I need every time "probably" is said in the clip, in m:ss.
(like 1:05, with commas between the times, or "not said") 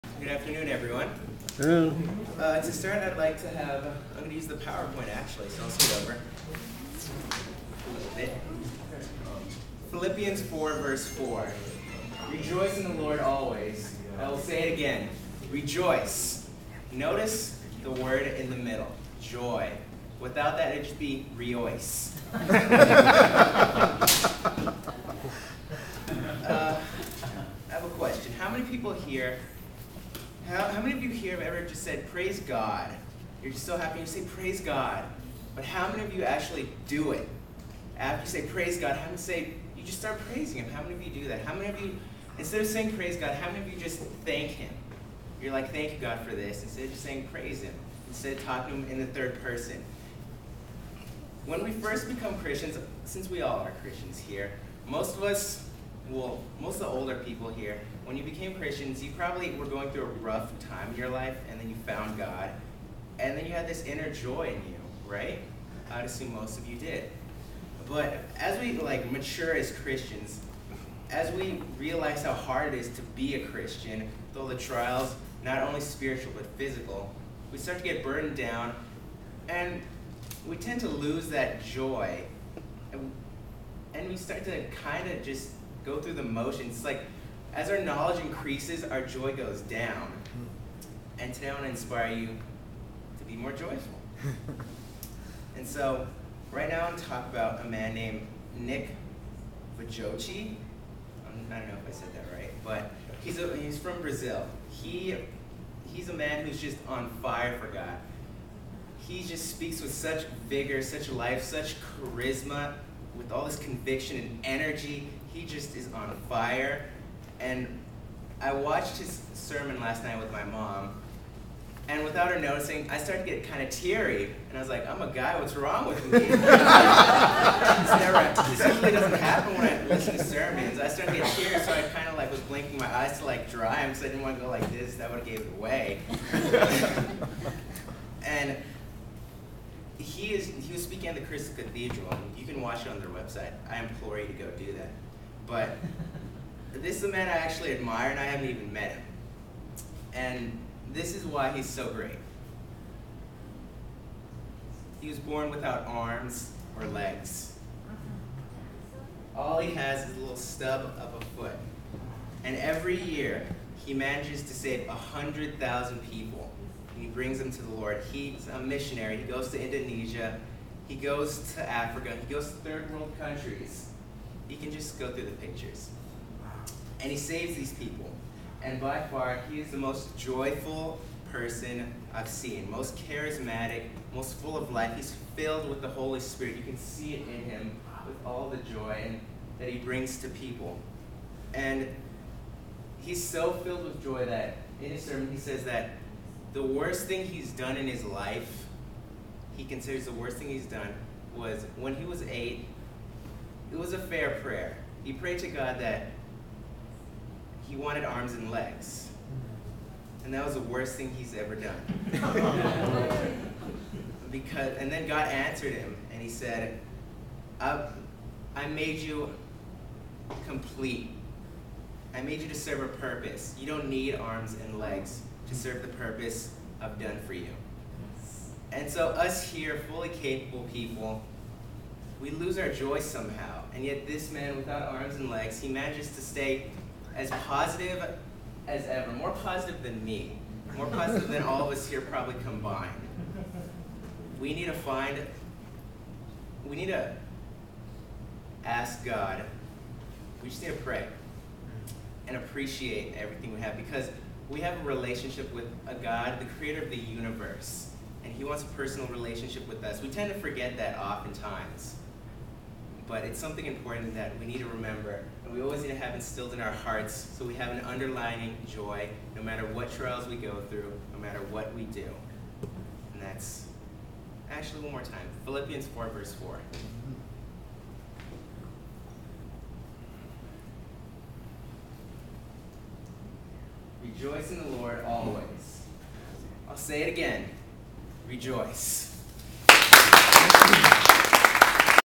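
0:59, 4:02.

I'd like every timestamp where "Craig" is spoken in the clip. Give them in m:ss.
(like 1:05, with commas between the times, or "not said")
not said.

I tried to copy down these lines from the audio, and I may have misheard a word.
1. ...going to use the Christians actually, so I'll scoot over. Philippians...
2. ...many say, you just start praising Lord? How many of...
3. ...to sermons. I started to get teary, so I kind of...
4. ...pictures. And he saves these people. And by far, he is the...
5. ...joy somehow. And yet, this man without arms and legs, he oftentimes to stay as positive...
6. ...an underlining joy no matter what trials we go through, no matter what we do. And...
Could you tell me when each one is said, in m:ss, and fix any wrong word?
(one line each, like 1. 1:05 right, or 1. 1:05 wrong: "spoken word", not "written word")
1. 0:04 wrong: "PowerPoint", not "Christians"
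2. 0:39 wrong: "Him", not "Lord"
3. 2:10 right
4. 2:55 right
5. 3:52 wrong: "manages", not "oftentimes"
6. 4:27 right.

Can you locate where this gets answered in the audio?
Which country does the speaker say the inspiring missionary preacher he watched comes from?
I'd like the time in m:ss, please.
1:44.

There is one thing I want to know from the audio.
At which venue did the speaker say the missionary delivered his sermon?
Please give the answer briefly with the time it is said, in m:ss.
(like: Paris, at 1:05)
Crystal Cathedral, at 2:21.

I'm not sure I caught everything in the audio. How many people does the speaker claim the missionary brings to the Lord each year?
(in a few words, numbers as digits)
100,000.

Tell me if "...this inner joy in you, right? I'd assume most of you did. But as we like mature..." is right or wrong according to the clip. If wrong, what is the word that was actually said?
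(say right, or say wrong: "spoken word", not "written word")
right.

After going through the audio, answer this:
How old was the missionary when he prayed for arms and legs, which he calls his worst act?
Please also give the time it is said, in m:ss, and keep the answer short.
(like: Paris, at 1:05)
8, at 3:22.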